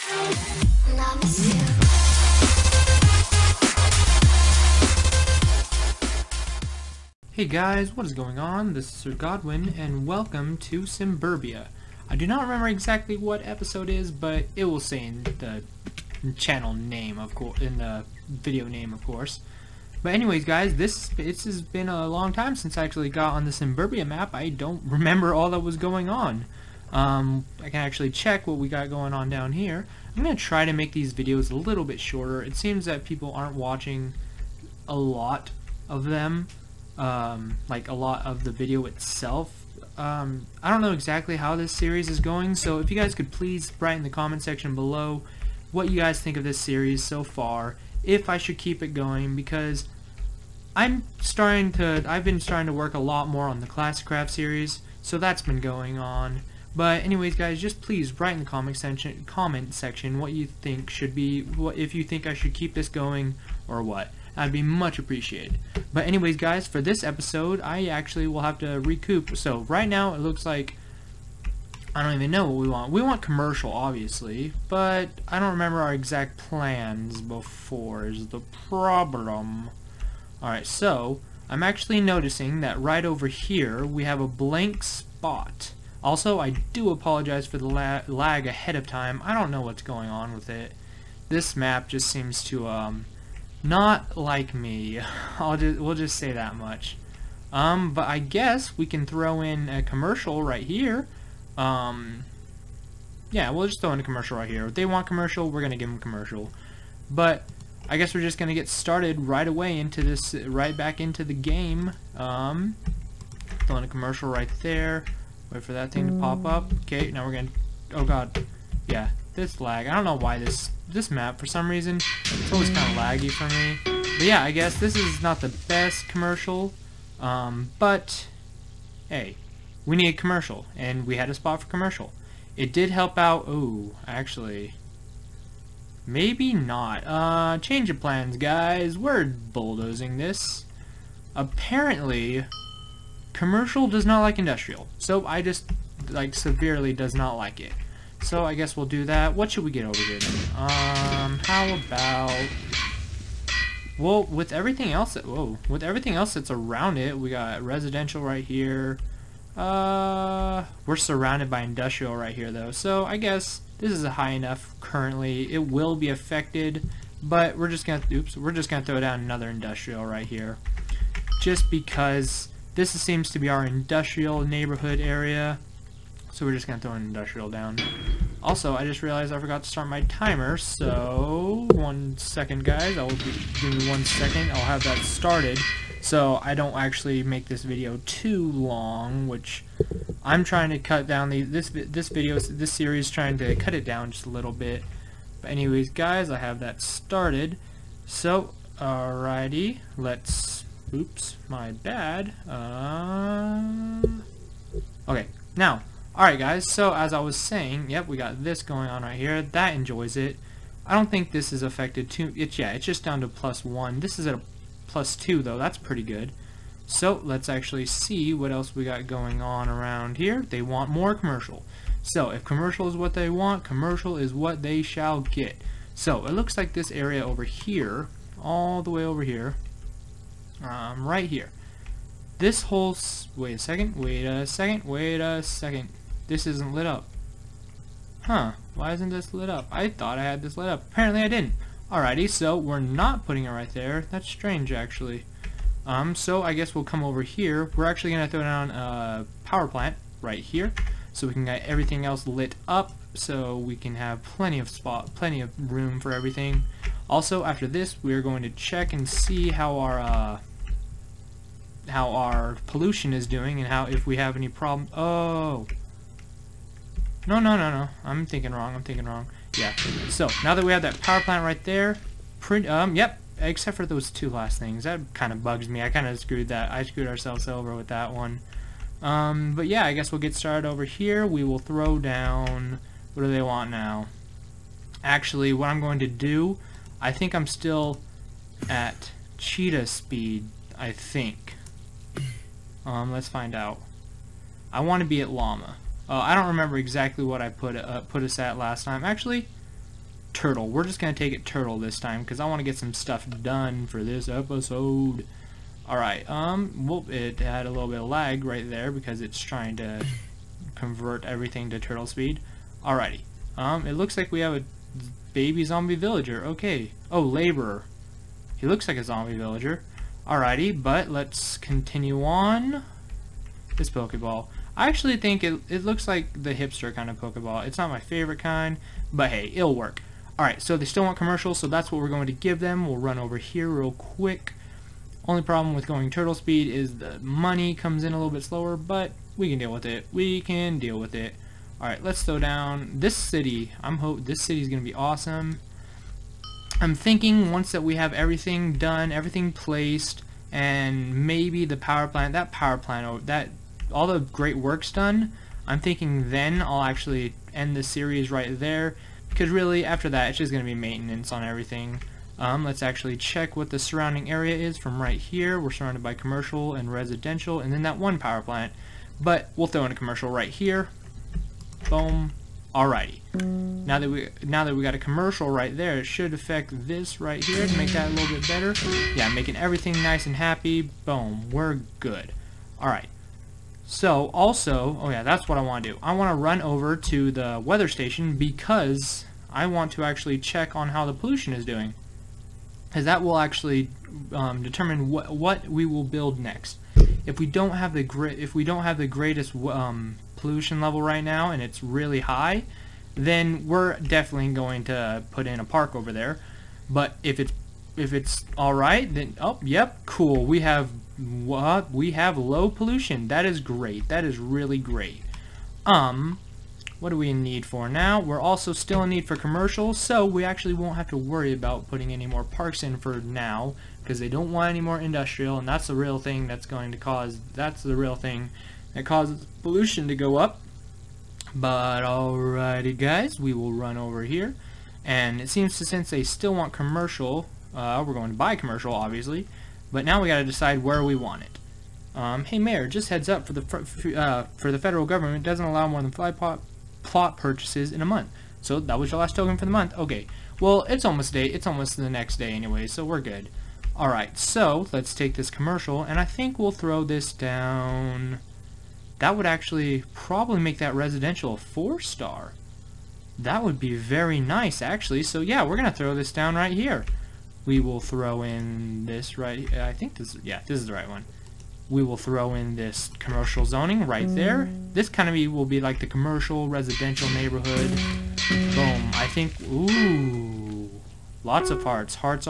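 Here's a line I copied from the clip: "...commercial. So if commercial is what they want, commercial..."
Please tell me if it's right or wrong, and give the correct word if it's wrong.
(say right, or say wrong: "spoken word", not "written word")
right.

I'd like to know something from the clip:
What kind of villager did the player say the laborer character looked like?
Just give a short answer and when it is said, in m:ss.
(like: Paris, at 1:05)
Baby zombie villager, at 5:15.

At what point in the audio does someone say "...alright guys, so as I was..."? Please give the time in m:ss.
3:26.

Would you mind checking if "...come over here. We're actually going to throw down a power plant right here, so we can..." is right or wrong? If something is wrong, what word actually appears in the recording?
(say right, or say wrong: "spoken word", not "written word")
right.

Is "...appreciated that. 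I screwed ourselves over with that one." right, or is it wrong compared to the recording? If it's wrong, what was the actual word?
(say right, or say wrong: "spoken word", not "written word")
wrong: "screwed", not "appreciated".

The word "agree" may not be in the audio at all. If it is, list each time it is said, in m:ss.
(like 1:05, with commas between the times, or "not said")
not said.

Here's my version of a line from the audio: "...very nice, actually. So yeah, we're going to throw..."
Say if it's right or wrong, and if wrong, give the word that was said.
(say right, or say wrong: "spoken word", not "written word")
right.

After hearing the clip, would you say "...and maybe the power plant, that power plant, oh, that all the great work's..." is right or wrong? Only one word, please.
right.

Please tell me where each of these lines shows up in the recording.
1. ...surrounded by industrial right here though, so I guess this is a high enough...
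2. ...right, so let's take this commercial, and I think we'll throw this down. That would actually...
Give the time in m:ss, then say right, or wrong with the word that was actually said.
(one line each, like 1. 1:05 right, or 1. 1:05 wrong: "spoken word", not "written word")
1. 2:40 right
2. 7:34 right.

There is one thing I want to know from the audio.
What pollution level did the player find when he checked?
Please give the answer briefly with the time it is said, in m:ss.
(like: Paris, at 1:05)
Low, at 6:52.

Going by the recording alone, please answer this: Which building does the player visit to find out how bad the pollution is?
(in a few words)
Weather station.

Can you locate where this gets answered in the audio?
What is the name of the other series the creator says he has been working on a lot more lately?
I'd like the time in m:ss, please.
0:53.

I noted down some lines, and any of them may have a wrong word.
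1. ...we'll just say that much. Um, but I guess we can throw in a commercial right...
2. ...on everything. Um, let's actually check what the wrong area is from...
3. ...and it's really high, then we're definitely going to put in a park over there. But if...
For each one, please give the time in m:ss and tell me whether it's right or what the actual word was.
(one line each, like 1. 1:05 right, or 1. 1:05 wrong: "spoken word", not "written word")
1. 1:35 right
2. 6:01 wrong: "surrounding", not "wrong"
3. 6:41 right.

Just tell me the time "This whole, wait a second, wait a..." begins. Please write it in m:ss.
3:52.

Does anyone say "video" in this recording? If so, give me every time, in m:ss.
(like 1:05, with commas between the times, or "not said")
0:18, 0:31, 0:38, 3:07, 3:12.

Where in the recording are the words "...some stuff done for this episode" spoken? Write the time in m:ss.
5:02.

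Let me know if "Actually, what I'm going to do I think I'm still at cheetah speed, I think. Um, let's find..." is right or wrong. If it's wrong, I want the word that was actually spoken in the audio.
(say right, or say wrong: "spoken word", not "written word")
right.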